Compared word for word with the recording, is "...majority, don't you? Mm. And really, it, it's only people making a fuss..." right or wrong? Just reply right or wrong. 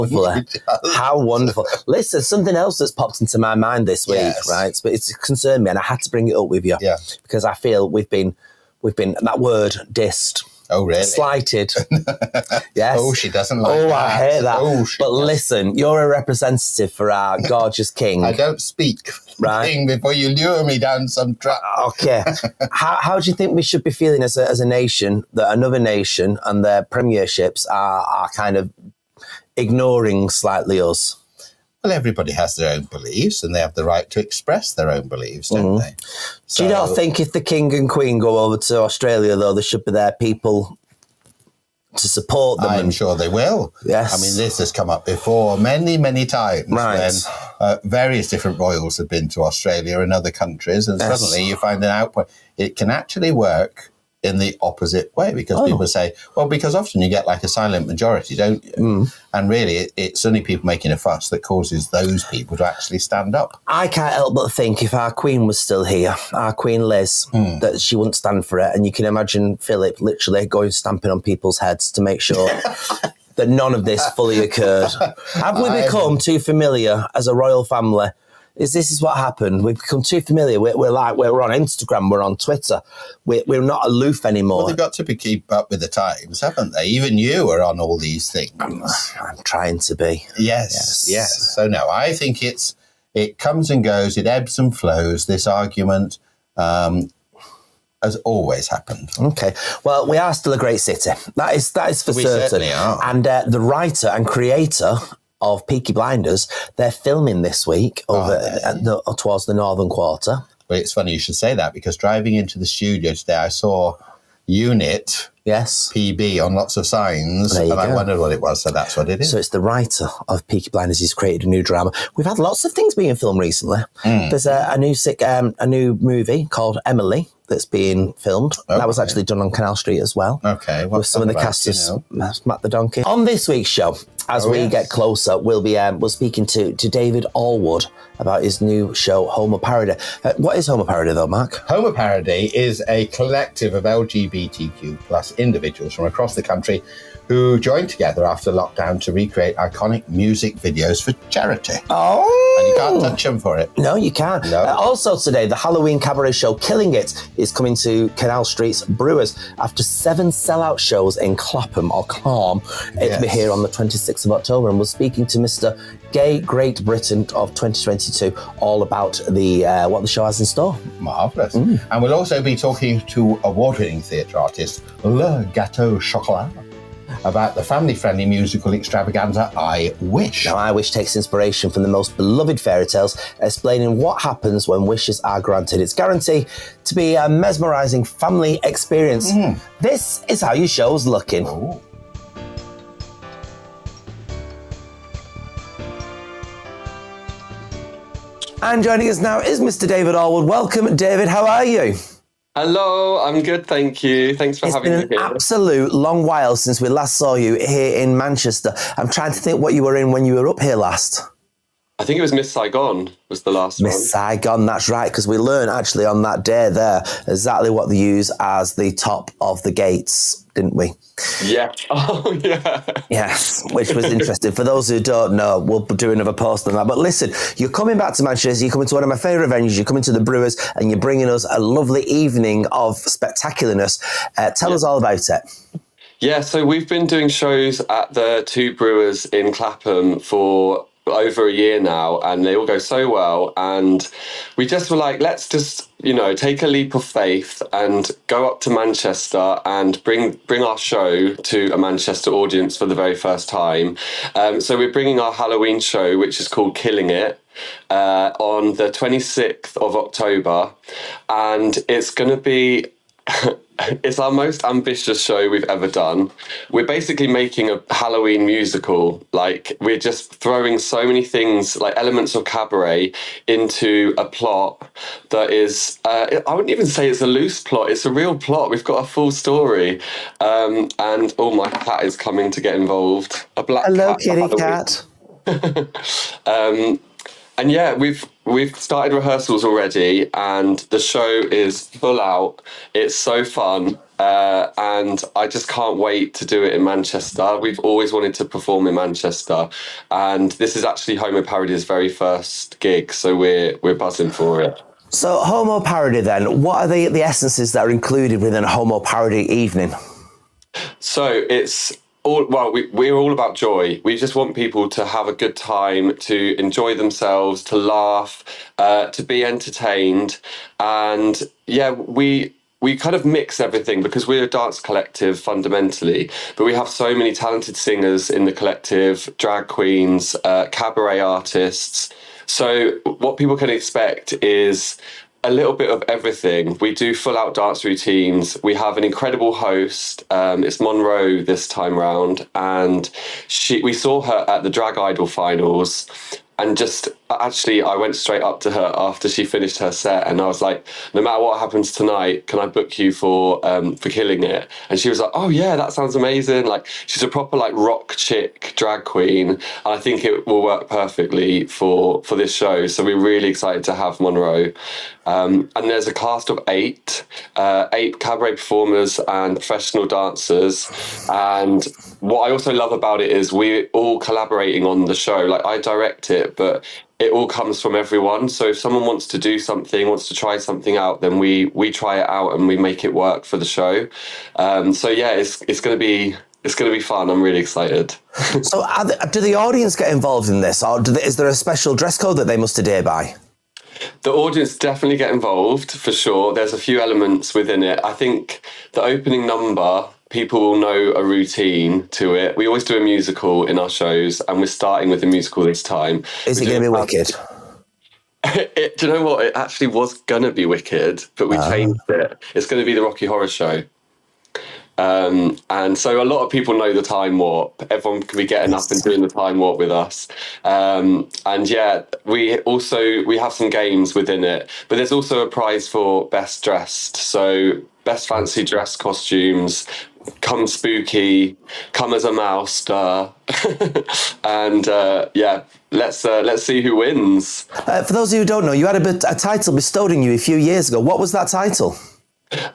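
right.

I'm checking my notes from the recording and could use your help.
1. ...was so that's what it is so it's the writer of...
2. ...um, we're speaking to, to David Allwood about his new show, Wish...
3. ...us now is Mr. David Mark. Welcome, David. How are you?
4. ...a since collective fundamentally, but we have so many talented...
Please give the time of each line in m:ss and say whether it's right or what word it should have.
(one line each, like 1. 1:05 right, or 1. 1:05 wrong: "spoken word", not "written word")
1. 1:58 right
2. 2:15 wrong: "Homo", not "Wish"
3. 3:19 wrong: "Allwood", not "Mark"
4. 5:24 wrong: "dance", not "since".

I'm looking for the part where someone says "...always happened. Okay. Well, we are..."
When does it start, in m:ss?
1:38.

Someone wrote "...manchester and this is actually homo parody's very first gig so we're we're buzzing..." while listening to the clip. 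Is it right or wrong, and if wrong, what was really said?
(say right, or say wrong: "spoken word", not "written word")
right.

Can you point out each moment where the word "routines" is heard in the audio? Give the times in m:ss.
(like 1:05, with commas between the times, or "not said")
5:37, 6:41.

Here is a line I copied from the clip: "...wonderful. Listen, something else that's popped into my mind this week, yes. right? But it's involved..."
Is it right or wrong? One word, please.
wrong.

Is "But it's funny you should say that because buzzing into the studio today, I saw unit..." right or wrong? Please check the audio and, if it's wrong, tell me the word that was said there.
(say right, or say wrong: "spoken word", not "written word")
wrong: "driving", not "buzzing".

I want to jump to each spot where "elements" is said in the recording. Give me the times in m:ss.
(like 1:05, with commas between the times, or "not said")
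4:31, 6:37.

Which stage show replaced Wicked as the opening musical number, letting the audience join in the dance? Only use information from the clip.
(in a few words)
The Rocky Horror Show.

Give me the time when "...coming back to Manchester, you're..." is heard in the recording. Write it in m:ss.
3:47.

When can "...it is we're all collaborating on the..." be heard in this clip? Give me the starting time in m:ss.
6:13.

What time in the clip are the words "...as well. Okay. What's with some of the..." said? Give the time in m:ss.
2:10.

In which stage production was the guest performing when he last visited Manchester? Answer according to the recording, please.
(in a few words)
Miss Saigon.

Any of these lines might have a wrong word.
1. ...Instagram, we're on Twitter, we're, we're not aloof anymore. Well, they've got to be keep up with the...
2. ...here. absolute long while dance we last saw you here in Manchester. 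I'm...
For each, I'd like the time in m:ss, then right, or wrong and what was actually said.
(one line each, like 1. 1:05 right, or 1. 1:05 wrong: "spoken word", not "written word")
1. 1:21 right
2. 3:25 wrong: "since", not "dance".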